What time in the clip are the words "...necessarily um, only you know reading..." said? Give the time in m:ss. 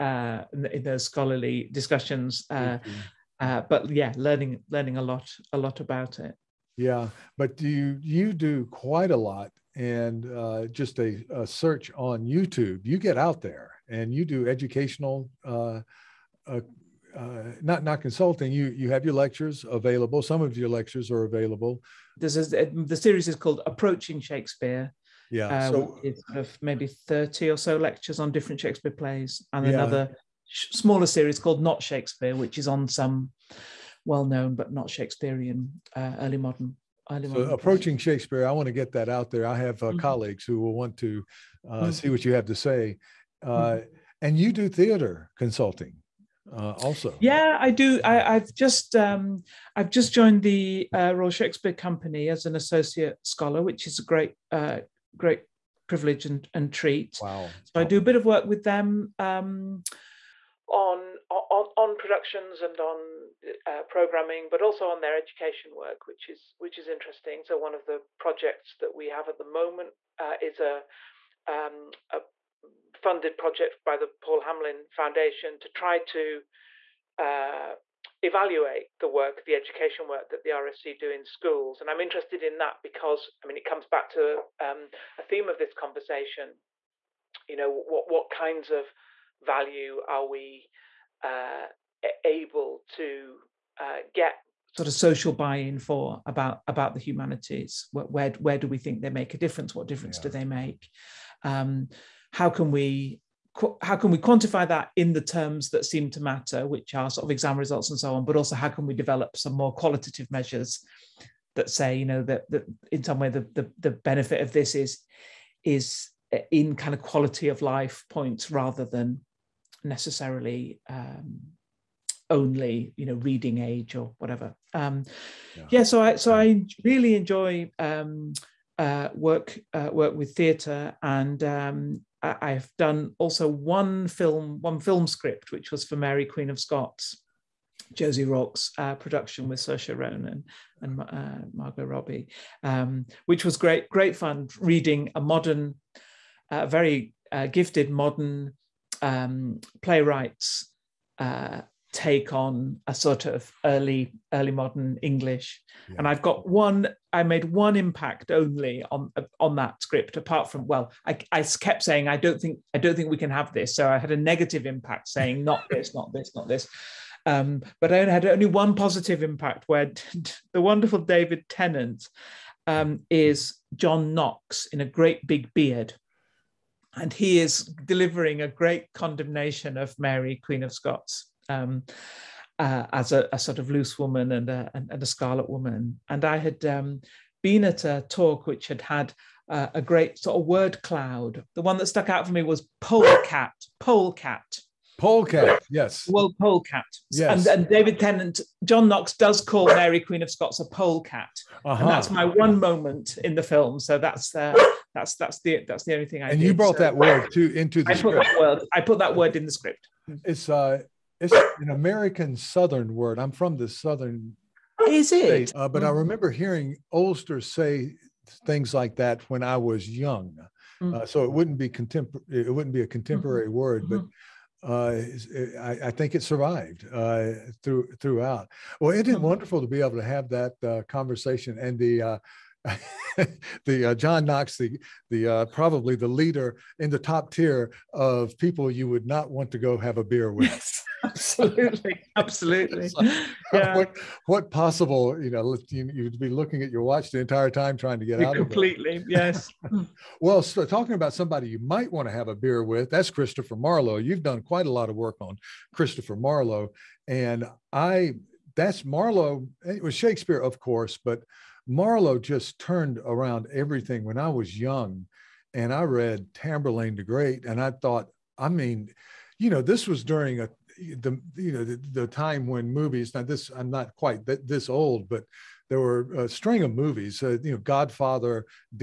1:59.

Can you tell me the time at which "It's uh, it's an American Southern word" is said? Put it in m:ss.
3:30.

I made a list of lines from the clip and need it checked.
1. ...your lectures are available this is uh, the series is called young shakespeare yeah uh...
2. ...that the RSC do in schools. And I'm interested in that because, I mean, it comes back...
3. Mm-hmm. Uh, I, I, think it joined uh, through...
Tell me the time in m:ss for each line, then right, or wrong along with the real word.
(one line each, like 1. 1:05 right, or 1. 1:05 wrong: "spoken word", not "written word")
1. 0:20 wrong: "approaching", not "young"
2. 1:20 right
3. 3:43 wrong: "survived", not "joined".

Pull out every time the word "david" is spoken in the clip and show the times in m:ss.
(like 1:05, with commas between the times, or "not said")
2:50, 3:17.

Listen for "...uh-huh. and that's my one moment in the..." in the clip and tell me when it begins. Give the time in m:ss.
3:21.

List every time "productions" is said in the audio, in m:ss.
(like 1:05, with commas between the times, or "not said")
1:01, 2:18.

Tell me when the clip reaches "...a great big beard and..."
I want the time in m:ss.
2:54.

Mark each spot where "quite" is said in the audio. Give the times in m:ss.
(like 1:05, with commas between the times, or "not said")
0:08, 4:14, 4:33.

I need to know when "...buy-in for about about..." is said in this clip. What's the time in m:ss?
1:35.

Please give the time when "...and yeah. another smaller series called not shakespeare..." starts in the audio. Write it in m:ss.
0:29.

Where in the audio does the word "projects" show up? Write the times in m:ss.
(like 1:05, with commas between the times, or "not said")
1:08, 1:13.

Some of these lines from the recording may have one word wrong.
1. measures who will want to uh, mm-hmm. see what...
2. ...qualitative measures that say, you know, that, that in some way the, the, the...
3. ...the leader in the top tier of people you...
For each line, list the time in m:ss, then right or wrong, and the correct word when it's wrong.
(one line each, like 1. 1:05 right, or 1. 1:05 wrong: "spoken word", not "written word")
1. 0:39 wrong: "colleagues", not "measures"
2. 1:49 right
3. 3:55 right.